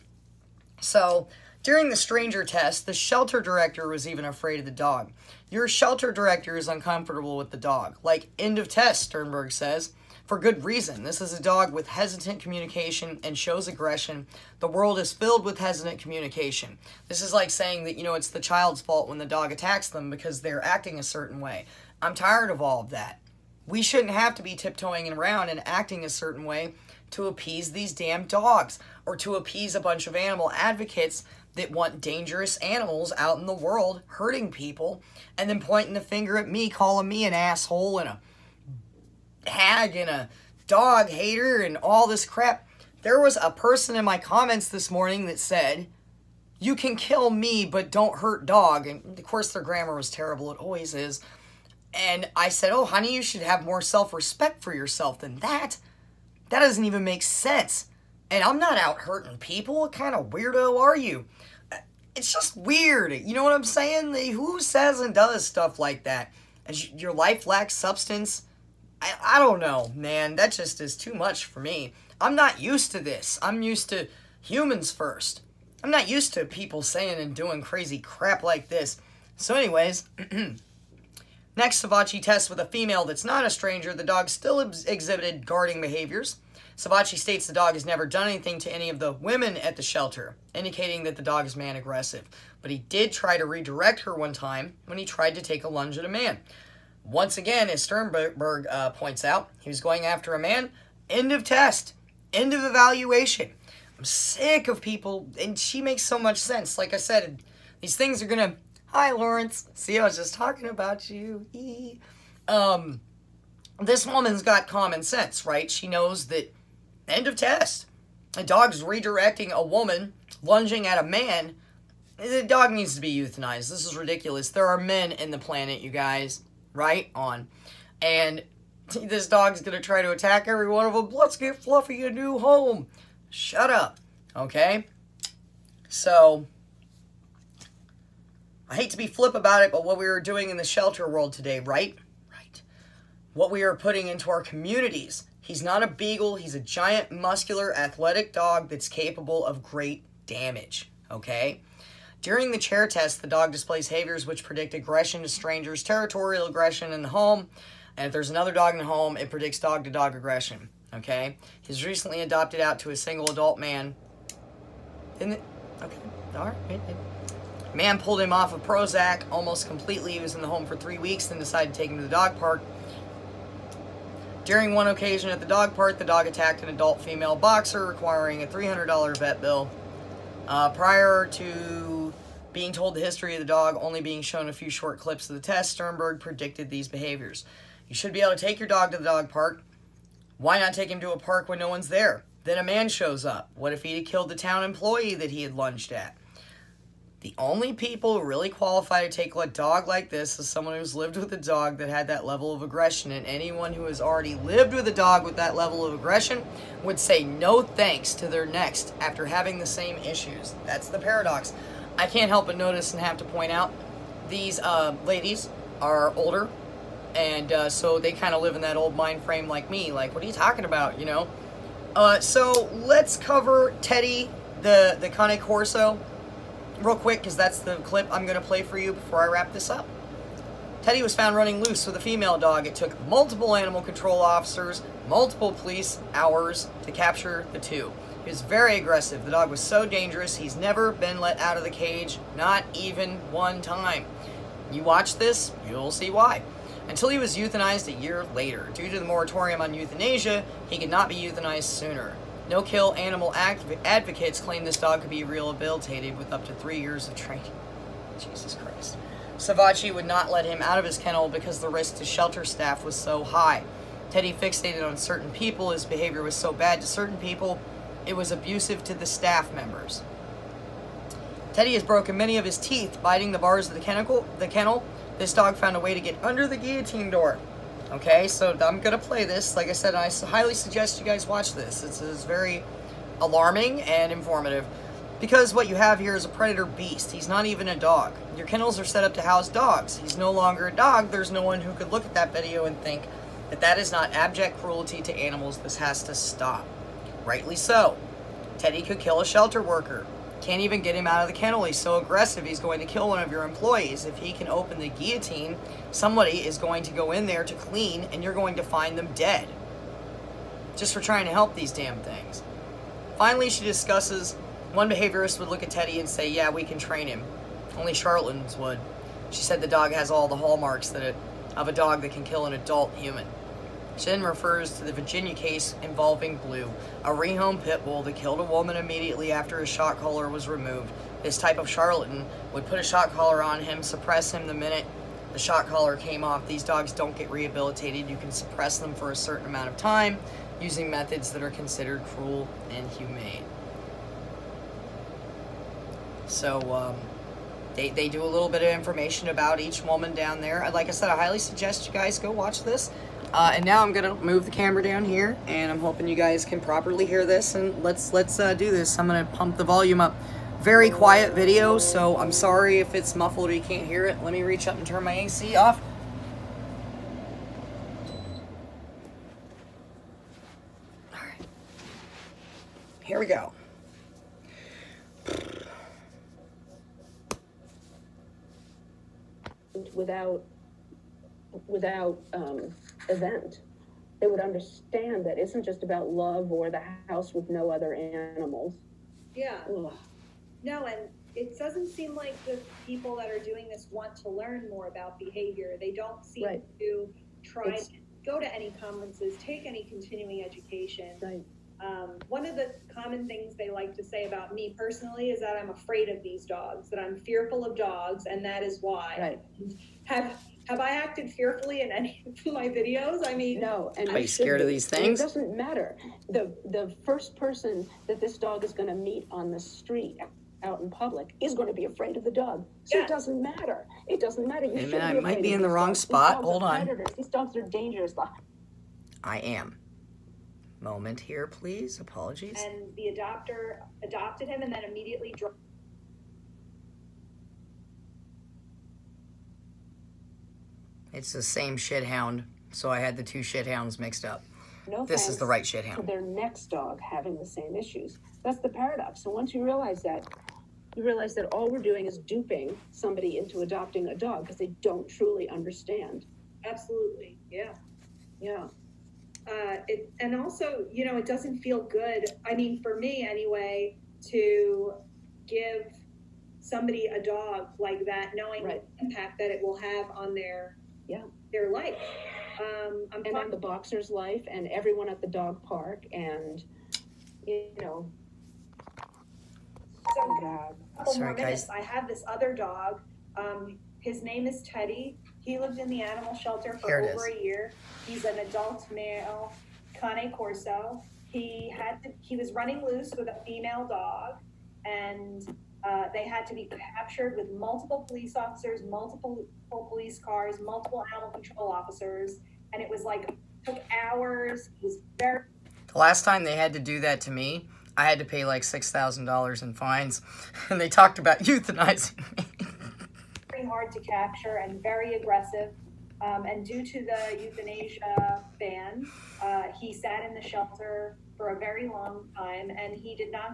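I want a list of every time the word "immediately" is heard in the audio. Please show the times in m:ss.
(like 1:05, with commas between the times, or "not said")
5:28, 7:14.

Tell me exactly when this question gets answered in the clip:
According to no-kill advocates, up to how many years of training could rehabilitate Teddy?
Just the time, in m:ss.
4:16.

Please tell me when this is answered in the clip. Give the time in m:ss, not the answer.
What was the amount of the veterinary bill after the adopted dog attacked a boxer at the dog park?
2:58.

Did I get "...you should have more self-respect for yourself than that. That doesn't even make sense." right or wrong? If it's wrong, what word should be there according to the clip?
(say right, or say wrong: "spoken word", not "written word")
right.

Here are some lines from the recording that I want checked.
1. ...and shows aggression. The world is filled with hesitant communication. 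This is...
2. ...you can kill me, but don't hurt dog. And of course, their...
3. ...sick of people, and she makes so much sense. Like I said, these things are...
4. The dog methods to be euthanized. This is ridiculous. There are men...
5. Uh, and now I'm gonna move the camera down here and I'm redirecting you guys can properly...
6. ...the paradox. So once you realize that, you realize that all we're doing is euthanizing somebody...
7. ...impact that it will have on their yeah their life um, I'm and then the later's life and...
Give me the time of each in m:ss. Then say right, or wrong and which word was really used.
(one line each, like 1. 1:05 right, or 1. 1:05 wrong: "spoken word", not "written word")
1. 0:13 right
2. 0:46 right
3. 1:44 right
4. 2:02 wrong: "needs", not "methods"
5. 5:53 wrong: "hoping", not "redirecting"
6. 7:28 wrong: "duping", not "euthanizing"
7. 7:49 wrong: "boxer", not "later".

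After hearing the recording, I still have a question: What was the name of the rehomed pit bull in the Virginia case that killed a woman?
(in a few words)
Blue.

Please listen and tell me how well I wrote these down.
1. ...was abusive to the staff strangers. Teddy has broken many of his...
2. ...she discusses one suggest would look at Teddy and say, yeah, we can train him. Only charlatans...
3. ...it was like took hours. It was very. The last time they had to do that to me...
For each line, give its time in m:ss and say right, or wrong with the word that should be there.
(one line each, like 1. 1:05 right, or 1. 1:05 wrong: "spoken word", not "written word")
1. 4:28 wrong: "members", not "strangers"
2. 5:13 wrong: "behaviorist", not "suggest"
3. 8:22 right.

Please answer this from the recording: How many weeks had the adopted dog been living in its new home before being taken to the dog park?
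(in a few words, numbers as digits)
3.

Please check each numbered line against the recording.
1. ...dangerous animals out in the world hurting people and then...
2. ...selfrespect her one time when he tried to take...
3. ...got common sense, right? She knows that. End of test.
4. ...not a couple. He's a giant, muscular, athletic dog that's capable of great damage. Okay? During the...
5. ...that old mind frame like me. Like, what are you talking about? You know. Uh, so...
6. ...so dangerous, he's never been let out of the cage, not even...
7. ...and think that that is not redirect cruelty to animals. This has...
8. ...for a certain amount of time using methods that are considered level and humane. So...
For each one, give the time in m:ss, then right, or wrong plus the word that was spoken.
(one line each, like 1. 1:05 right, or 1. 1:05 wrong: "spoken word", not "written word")
1. 0:32 right
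2. 1:33 wrong: "redirect", not "selfrespect"
3. 1:54 right
4. 2:25 wrong: "beagle", not "couple"
5. 3:38 right
6. 3:59 right
7. 4:52 wrong: "abject", not "redirect"
8. 5:38 wrong: "cruel", not "level".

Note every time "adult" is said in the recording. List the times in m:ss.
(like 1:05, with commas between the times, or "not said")
2:43, 2:56, 5:22, 8:08.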